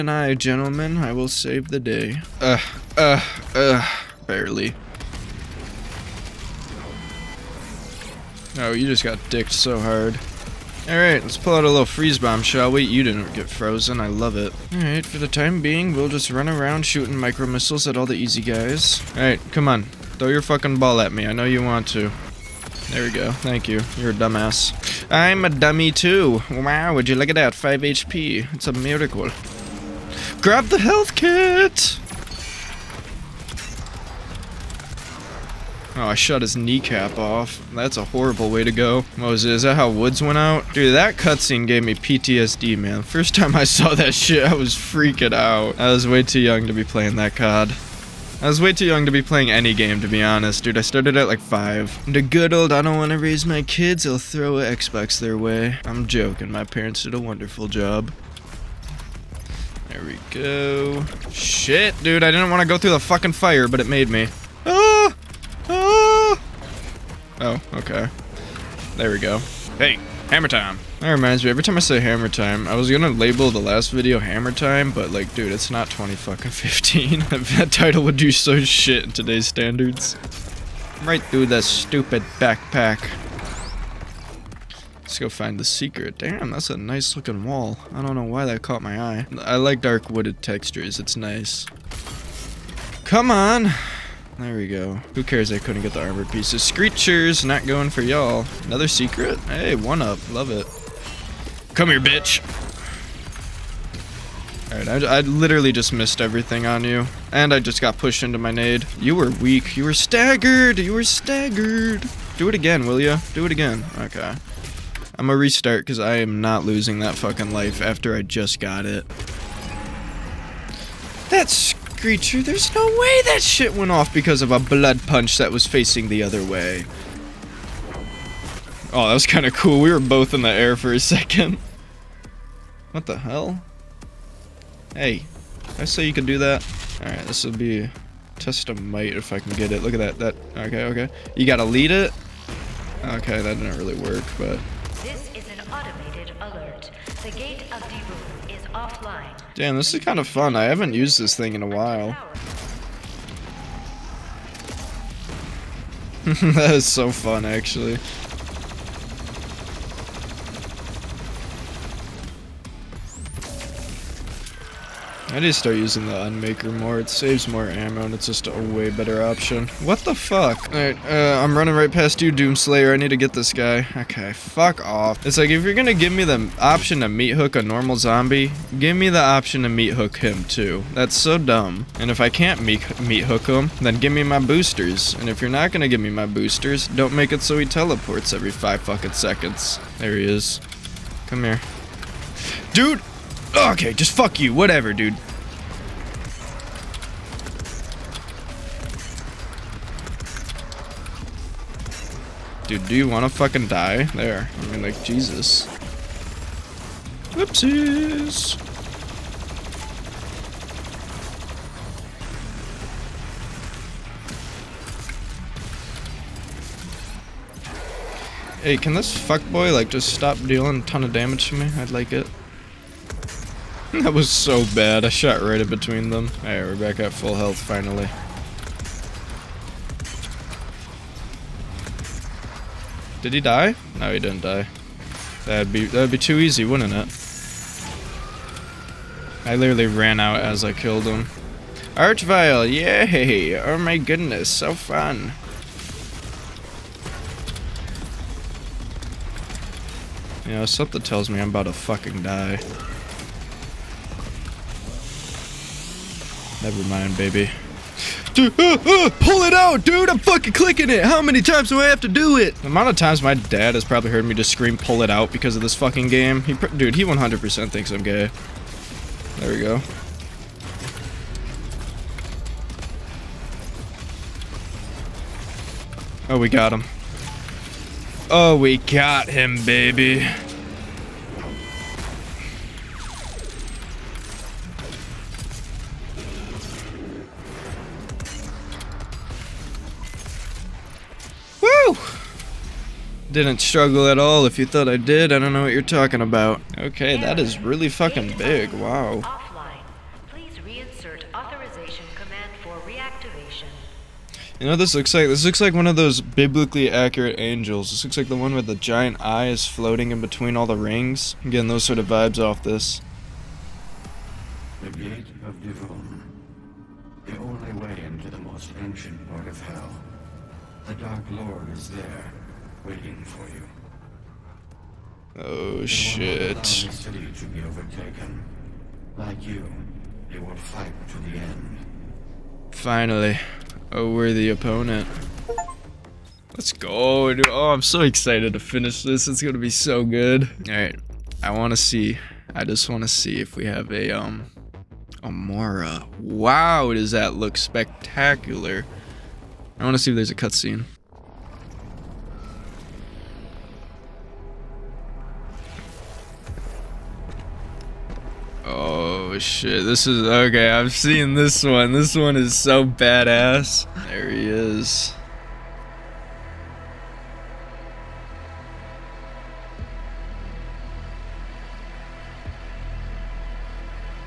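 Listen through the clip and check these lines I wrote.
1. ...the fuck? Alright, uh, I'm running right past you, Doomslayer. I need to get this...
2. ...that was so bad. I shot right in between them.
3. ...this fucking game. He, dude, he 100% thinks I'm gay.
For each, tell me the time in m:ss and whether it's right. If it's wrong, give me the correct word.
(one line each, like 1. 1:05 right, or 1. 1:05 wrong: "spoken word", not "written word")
1. 2:49 right
2. 3:43 right
3. 4:25 right.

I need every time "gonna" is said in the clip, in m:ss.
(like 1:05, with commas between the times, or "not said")
1:12, 1:55, 2:55, 3:05, 5:39.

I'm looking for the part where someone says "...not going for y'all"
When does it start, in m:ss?
1:37.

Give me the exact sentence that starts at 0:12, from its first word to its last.
You didn't get frozen, I love it.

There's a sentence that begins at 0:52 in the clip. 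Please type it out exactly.
The good old I don't want to raise my kids, i will throw an Xbox their way.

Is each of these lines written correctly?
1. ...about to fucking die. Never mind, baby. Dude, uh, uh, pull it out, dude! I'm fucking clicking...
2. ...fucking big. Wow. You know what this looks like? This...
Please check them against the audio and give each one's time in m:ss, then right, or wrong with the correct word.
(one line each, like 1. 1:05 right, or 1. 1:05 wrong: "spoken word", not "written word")
1. 4:11 right
2. 4:57 right.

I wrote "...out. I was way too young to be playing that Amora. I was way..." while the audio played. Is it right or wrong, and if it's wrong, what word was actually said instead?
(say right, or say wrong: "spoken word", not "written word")
wrong: "COD", not "Amora".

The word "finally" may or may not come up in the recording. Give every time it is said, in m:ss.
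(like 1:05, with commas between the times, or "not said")
3:47, 5:32.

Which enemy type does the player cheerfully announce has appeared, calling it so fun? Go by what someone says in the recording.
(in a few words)
Archvile.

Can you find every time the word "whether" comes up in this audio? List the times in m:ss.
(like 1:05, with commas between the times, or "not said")
not said.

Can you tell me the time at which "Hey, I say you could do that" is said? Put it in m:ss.
2:14.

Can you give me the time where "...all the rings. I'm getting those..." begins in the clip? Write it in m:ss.
5:10.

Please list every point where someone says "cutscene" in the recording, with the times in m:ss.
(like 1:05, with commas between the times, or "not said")
0:41, 5:50.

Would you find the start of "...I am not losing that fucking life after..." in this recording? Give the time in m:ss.
1:55.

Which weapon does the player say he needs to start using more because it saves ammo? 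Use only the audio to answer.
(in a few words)
The Unmaker.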